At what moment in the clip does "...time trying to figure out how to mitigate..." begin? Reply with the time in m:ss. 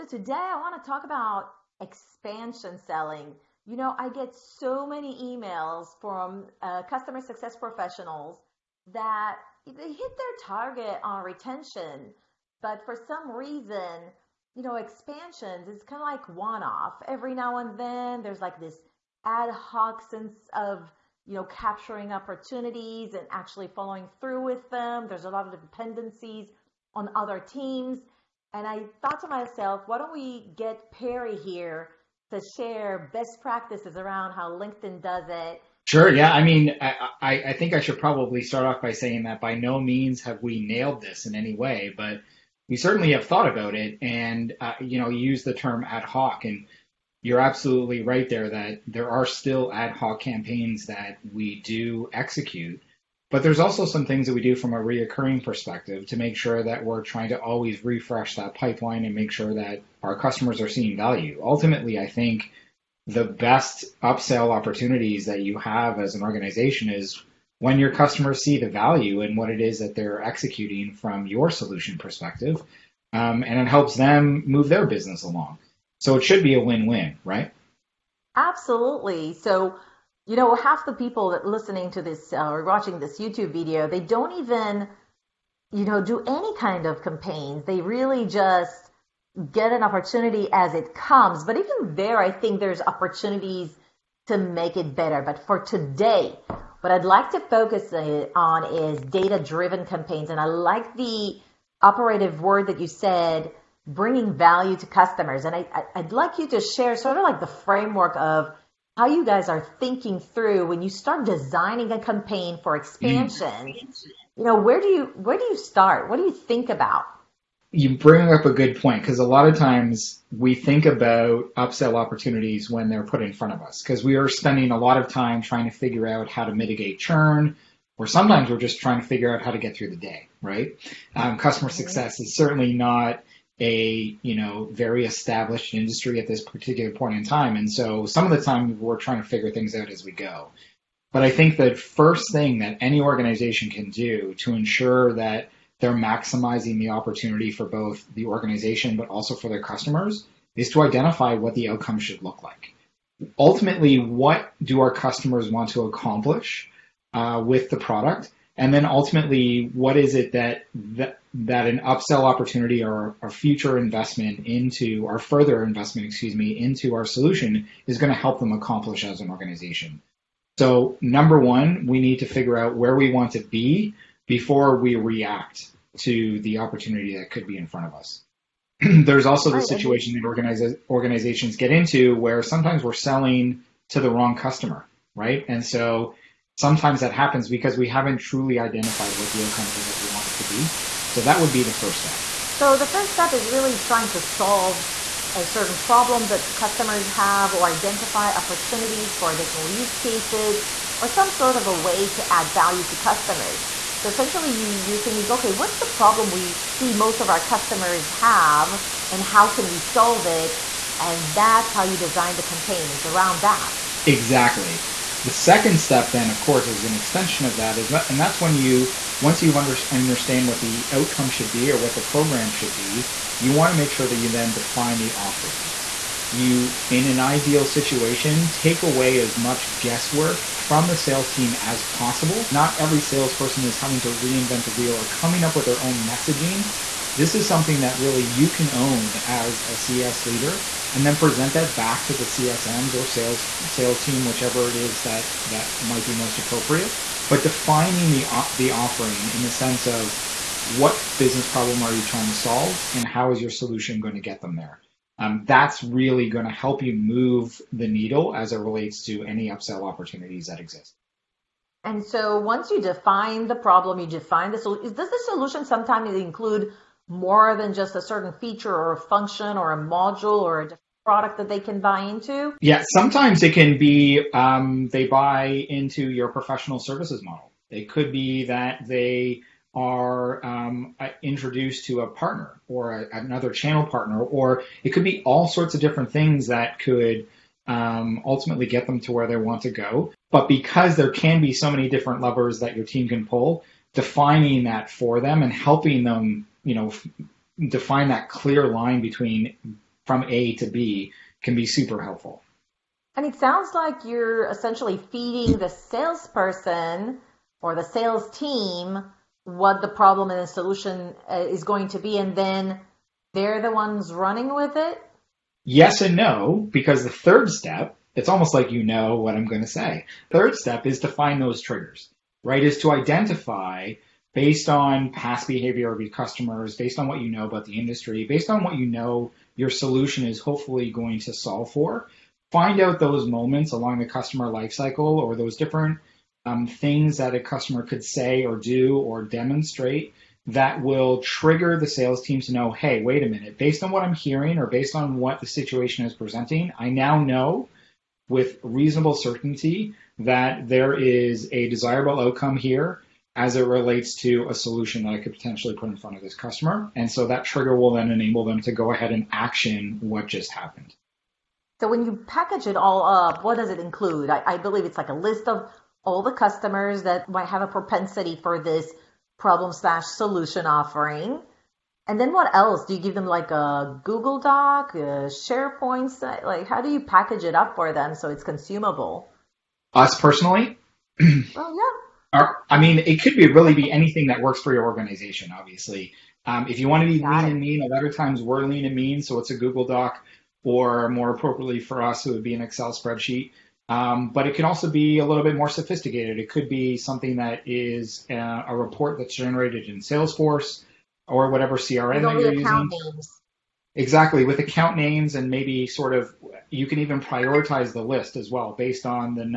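2:05.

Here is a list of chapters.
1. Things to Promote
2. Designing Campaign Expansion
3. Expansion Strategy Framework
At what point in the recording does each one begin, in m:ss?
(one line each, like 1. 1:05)
1. 4:32
2. 1:48
3. 3:12.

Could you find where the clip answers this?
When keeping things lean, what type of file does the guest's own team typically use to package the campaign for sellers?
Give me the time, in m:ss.
6:32.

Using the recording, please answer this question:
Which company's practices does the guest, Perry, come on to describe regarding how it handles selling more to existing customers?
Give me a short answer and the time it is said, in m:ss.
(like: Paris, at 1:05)
LinkedIn, at 0:34.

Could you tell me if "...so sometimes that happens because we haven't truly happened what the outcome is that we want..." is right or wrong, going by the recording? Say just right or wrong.
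wrong.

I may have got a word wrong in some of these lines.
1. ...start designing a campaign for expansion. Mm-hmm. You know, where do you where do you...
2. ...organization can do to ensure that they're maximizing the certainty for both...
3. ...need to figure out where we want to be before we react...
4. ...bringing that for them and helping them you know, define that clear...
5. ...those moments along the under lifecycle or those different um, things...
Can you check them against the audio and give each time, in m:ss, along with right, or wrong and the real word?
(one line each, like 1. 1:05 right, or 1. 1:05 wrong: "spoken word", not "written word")
1. 1:50 right
2. 2:22 wrong: "opportunity", not "certainty"
3. 2:51 right
4. 4:53 wrong: "defining", not "bringing"
5. 5:32 wrong: "customer", not "under".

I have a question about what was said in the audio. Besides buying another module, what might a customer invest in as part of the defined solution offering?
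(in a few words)
professional services.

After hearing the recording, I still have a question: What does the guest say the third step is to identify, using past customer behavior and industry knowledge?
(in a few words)
triggers.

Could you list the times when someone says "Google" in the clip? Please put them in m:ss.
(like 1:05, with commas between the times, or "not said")
6:14, 6:29.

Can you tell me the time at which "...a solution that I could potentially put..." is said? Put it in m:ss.
5:54.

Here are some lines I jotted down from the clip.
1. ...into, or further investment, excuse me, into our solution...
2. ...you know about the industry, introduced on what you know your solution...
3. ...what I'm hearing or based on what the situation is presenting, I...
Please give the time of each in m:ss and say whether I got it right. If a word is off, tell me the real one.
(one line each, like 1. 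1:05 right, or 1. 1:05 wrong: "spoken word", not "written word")
1. 2:44 right
2. 5:27 wrong: "based", not "introduced"
3. 5:43 right.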